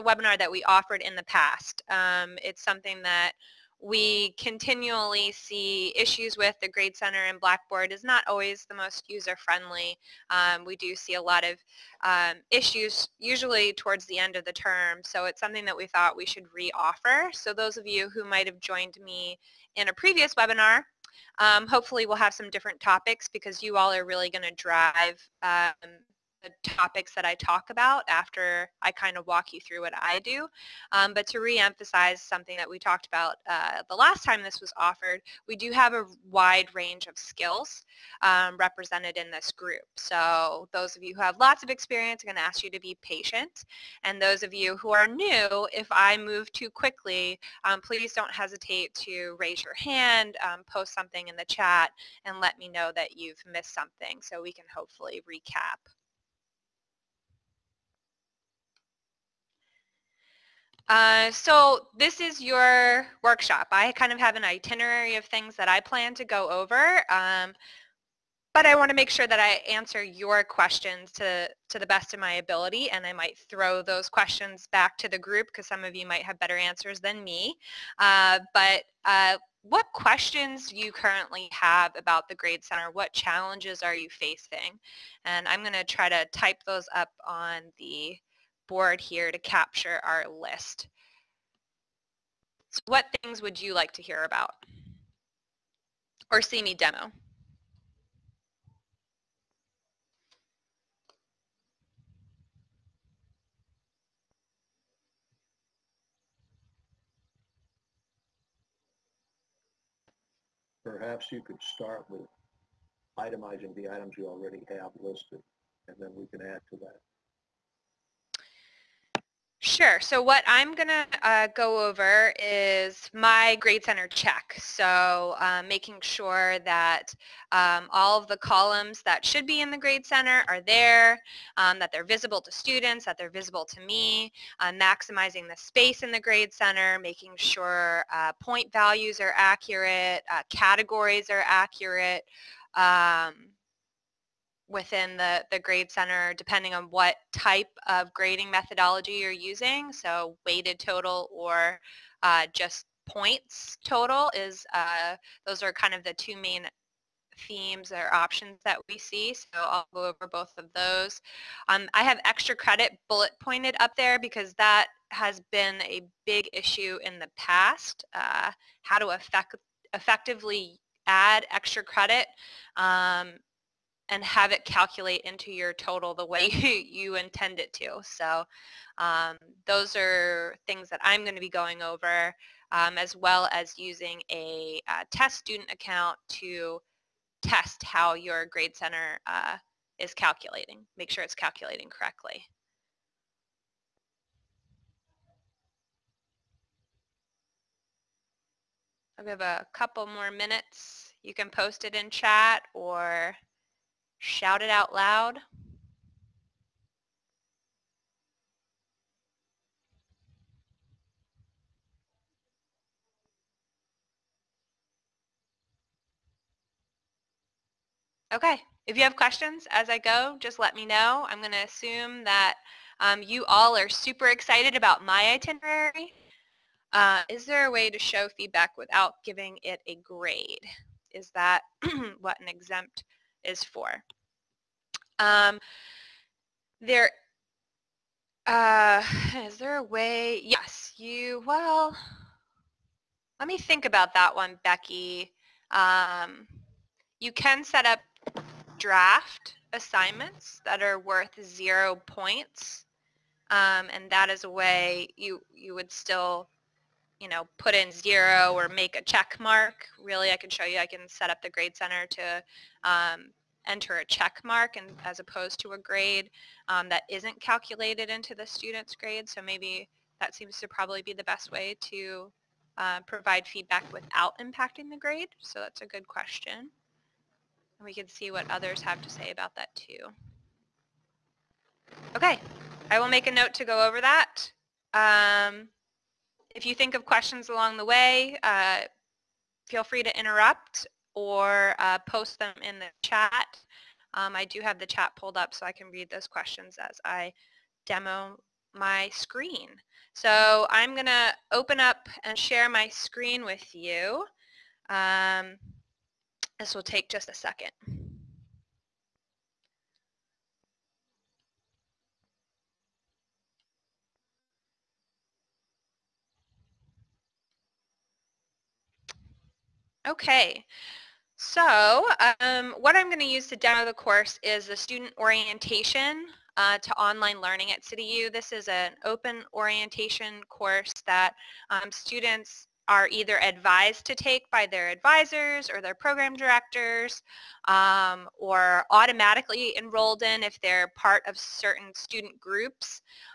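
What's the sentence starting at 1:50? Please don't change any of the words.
Perhaps you could start with itemizing the items you already have listed, and then we can add to that.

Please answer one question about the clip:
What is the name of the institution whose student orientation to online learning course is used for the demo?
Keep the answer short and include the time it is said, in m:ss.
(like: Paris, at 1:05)
CityU, at 5:27.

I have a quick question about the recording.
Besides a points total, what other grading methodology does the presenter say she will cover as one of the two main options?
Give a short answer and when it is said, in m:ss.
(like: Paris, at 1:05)
Weighted total, at 2:30.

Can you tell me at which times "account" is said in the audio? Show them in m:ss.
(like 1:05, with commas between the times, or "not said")
3:05.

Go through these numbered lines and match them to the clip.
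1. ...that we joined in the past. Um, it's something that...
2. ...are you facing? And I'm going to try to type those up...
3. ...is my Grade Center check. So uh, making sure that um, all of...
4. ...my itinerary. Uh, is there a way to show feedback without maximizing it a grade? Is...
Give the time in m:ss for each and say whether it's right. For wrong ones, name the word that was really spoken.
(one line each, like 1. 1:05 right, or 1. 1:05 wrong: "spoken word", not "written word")
1. 0:00 wrong: "offered", not "joined"
2. 1:23 right
3. 2:02 right
4. 3:45 wrong: "giving", not "maximizing".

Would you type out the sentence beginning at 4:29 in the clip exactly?
So maybe that seems to probably be the best way to uh, provide feedback without impacting the grade.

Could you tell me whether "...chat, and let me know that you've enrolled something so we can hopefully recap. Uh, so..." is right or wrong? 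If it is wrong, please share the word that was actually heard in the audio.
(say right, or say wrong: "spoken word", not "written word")
wrong: "missed", not "enrolled".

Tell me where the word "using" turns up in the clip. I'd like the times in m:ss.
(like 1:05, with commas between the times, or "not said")
2:29, 3:03.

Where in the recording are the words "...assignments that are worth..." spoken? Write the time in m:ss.
4:09.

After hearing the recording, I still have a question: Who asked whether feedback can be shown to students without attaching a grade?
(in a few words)
Becky.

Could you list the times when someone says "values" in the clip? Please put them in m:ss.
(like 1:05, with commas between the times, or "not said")
2:18.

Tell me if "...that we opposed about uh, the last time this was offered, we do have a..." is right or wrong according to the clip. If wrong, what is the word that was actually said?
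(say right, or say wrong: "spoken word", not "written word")
wrong: "talked", not "opposed".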